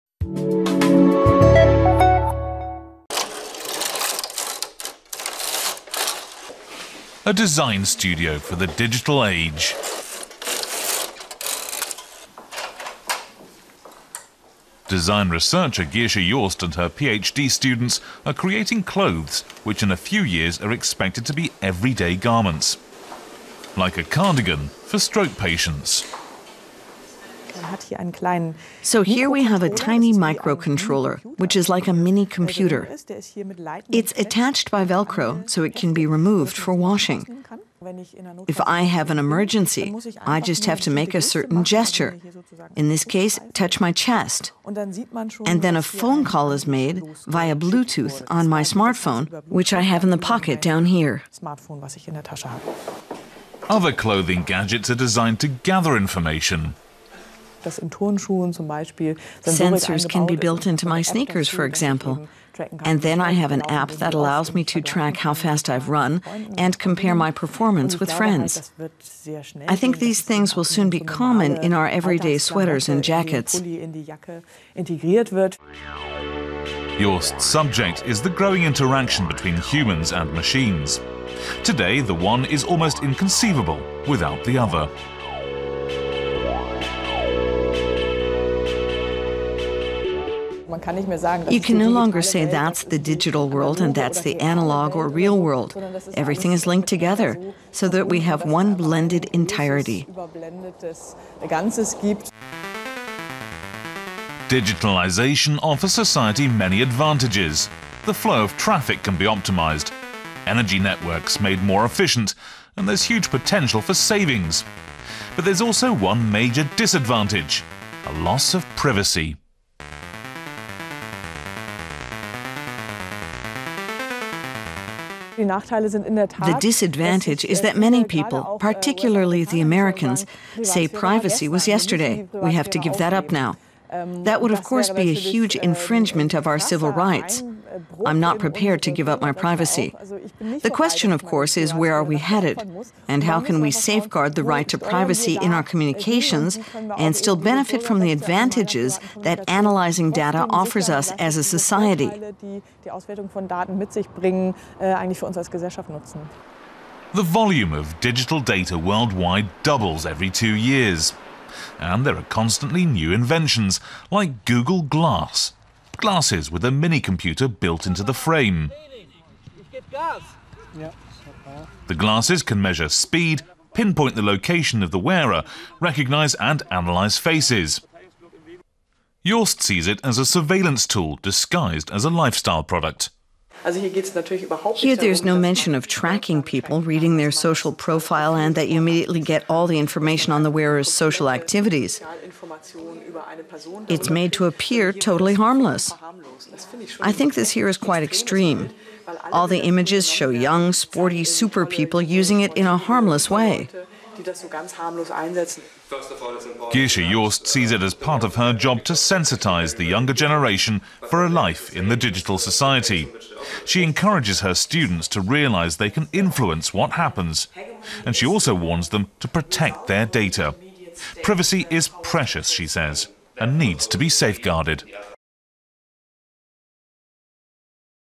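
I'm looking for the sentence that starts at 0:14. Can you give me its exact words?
Design researcher Gesche Joost and her PhD students are creating clothes which in a few years are expected to be everyday garments.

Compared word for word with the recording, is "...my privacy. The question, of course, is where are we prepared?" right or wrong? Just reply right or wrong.
wrong.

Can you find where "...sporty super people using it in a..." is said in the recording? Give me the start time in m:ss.
3:20.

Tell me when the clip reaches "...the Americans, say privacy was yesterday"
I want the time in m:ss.
2:09.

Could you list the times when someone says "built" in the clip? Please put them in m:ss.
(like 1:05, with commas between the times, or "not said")
1:00, 2:47.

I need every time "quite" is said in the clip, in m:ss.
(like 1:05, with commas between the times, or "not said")
3:17.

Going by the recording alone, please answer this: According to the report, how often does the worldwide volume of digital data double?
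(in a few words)
every 2 years.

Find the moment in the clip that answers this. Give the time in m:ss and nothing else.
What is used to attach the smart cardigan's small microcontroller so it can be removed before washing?
0:34.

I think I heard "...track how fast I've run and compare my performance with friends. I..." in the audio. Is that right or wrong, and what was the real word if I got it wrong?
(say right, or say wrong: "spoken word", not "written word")
right.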